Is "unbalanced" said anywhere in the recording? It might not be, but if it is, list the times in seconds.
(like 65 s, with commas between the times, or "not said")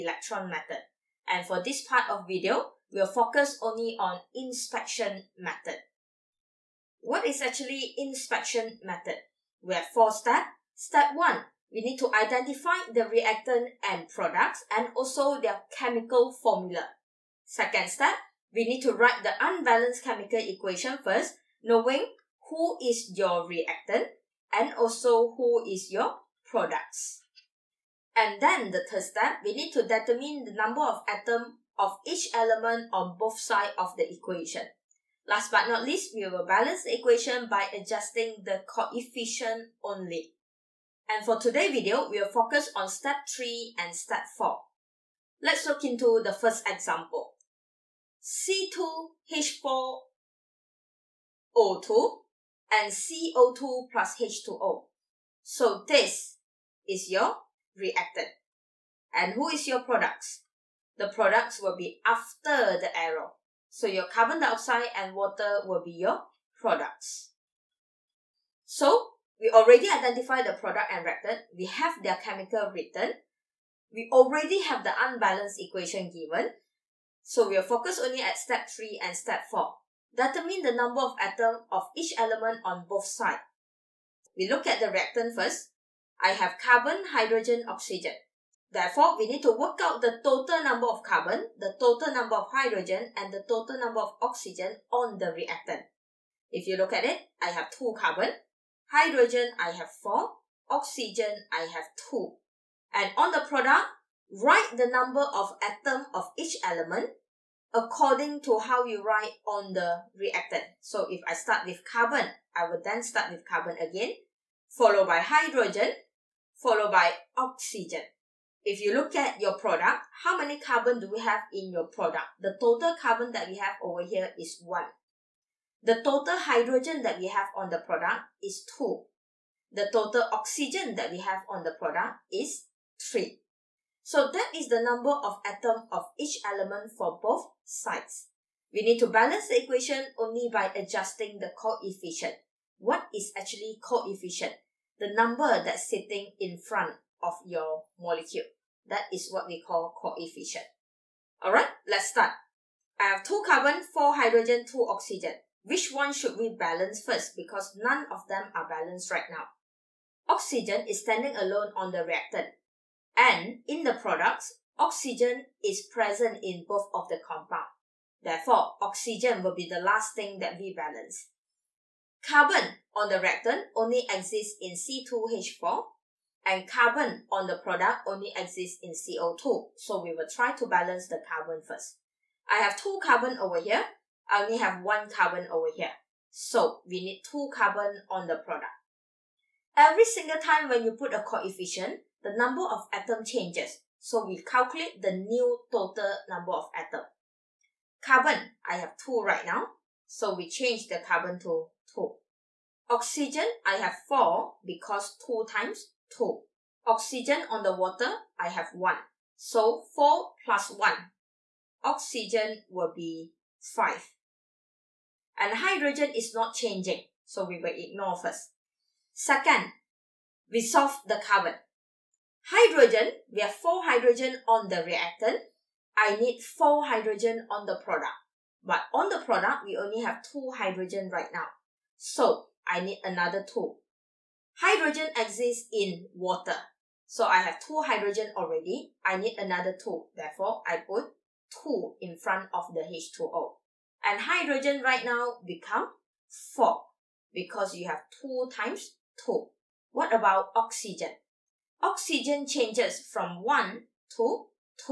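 19 s, 75 s.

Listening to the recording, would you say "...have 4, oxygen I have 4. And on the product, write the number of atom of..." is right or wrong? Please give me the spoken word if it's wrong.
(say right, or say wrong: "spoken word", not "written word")
wrong: "2", not "4".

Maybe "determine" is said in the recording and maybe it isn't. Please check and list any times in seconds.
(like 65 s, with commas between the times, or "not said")
29 s, 80 s.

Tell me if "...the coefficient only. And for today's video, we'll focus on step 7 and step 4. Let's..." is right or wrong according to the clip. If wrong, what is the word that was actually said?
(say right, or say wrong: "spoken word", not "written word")
wrong: "3", not "7".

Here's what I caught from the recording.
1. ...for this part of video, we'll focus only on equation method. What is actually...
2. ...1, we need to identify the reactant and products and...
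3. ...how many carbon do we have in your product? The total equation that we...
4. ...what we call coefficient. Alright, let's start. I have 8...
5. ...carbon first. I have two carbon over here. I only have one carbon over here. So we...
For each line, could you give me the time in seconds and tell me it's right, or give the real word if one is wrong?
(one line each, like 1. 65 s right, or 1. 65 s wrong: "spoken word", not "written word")
1. 1 s wrong: "inspection", not "equation"
2. 11 s right
3. 120 s wrong: "carbon", not "equation"
4. 149 s wrong: "2", not "8"
5. 181 s right.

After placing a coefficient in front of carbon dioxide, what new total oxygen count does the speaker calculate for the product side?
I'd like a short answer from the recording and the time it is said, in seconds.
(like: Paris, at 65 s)
5, at 211 s.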